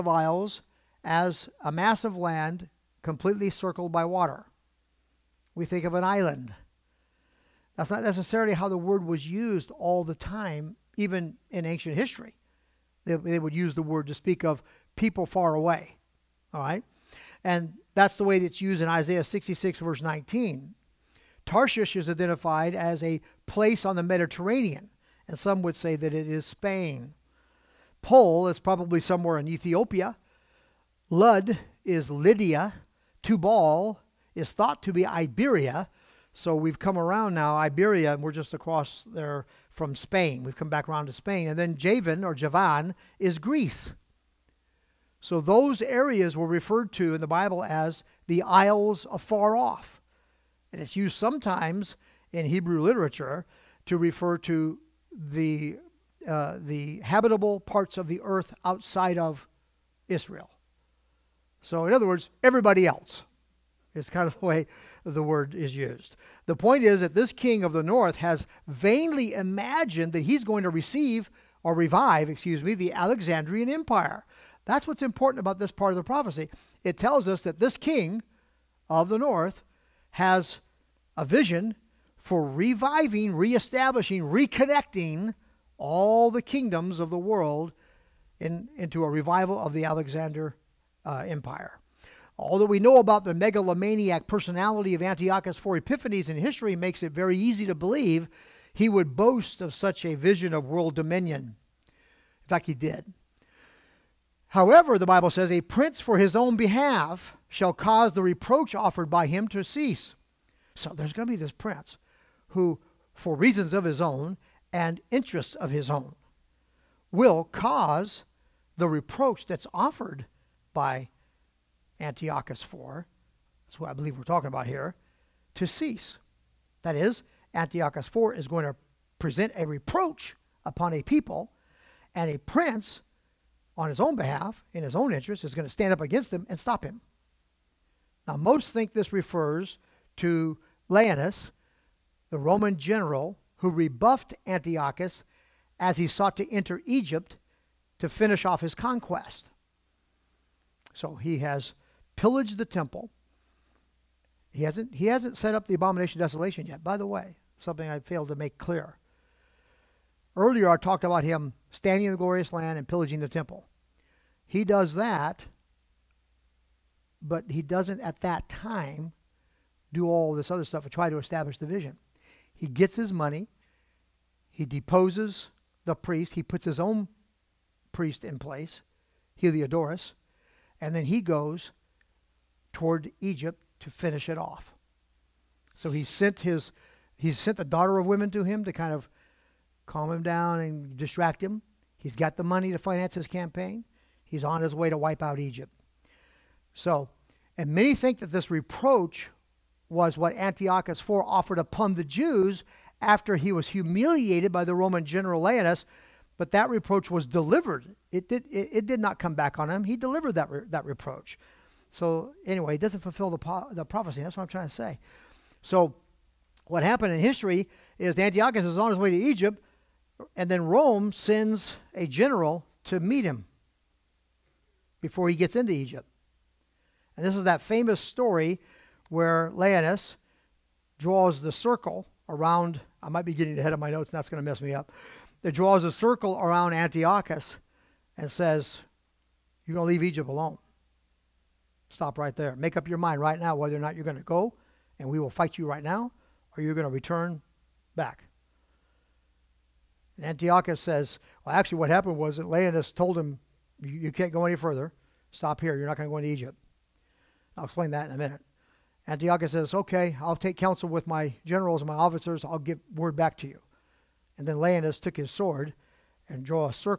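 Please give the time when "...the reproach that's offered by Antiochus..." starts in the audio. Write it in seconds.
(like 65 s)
118 s.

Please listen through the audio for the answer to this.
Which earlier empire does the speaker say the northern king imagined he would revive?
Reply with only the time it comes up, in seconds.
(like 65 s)
72 s.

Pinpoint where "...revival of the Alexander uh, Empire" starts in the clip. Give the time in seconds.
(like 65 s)
89 s.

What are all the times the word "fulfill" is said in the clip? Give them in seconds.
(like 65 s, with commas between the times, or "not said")
213 s.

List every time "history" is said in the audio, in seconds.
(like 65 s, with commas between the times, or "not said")
11 s, 96 s, 217 s.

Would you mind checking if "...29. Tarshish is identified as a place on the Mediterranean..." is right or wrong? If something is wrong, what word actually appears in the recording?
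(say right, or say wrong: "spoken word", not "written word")
wrong: "19", not "29".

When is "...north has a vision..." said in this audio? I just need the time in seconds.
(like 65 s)
79 s.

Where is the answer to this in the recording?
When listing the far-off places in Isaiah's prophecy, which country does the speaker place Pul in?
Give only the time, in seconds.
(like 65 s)
29 s.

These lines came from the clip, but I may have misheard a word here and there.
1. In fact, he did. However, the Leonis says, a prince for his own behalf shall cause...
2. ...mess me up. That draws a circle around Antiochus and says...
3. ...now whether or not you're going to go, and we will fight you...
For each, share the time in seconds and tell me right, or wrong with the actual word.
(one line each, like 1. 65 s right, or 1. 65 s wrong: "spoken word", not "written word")
1. 102 s wrong: "Bible", not "Leonis"
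2. 234 s right
3. 243 s right.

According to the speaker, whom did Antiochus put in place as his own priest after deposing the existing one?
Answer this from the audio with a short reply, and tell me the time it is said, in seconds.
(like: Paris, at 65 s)
Heliodorus, at 179 s.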